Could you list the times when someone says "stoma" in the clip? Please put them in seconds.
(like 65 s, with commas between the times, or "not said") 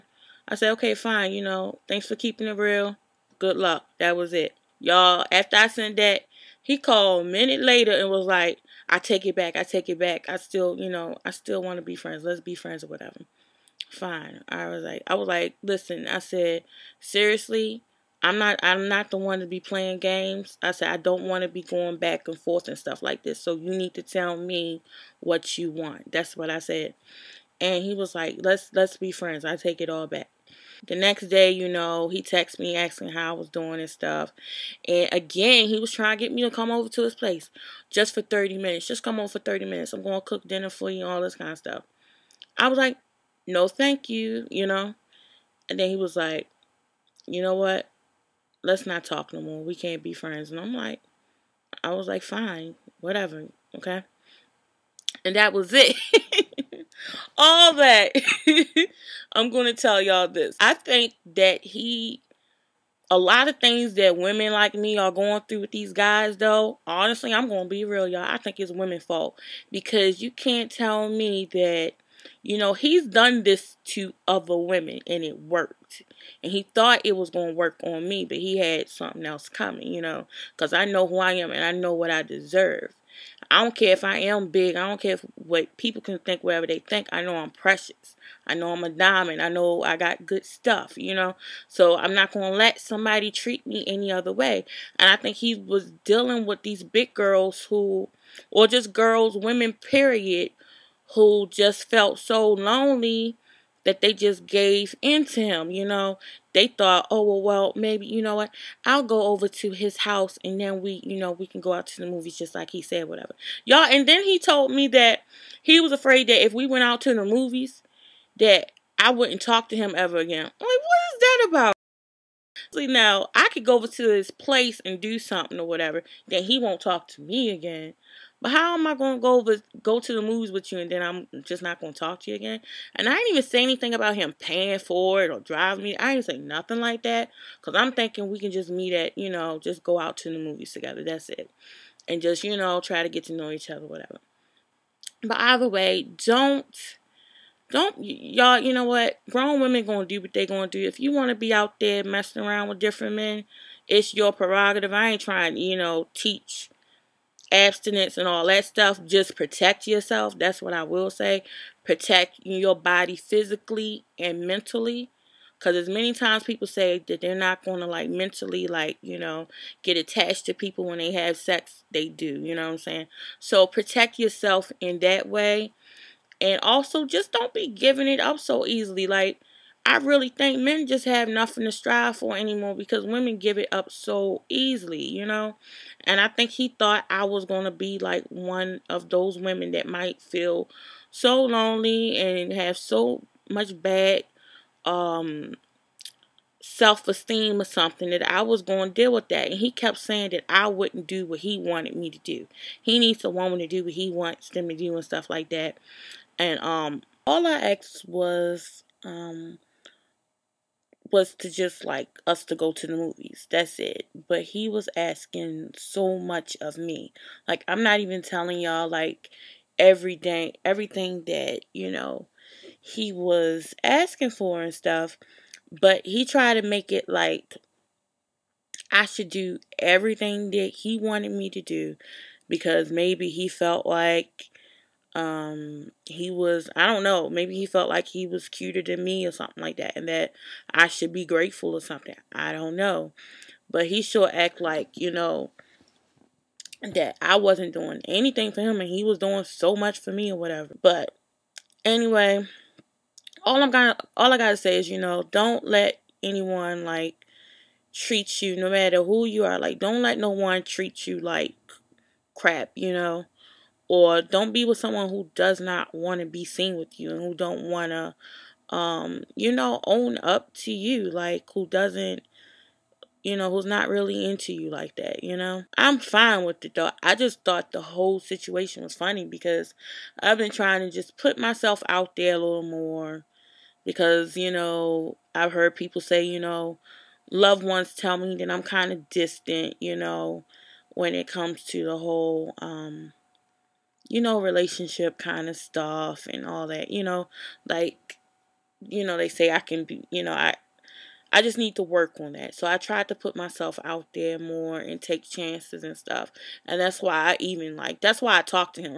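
not said.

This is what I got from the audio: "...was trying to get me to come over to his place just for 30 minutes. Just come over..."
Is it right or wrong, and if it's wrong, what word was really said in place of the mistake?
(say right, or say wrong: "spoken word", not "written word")
right.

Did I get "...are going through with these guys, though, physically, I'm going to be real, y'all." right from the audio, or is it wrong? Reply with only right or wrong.
wrong.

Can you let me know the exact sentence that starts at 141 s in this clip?
That's it, and just you know try to get to know each other, whatever.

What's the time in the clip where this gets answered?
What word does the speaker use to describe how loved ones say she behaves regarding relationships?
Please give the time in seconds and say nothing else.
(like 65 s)
289 s.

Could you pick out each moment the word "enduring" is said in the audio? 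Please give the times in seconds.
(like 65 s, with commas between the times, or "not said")
not said.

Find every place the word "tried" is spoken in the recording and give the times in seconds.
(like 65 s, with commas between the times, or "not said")
226 s, 302 s.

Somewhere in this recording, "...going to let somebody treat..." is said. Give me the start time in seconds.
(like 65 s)
92 s.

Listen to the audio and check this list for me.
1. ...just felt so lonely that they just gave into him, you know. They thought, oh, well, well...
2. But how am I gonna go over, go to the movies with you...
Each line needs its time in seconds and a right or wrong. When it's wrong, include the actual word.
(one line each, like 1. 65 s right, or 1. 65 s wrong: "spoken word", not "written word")
1. 101 s right
2. 128 s right.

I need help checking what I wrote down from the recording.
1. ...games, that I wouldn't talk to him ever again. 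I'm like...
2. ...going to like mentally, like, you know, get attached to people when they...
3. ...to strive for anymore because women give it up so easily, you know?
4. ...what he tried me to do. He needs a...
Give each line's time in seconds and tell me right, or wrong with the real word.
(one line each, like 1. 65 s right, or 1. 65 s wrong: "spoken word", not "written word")
1. 117 s wrong: "movies", not "games"
2. 167 s right
3. 181 s right
4. 201 s wrong: "wanted", not "tried".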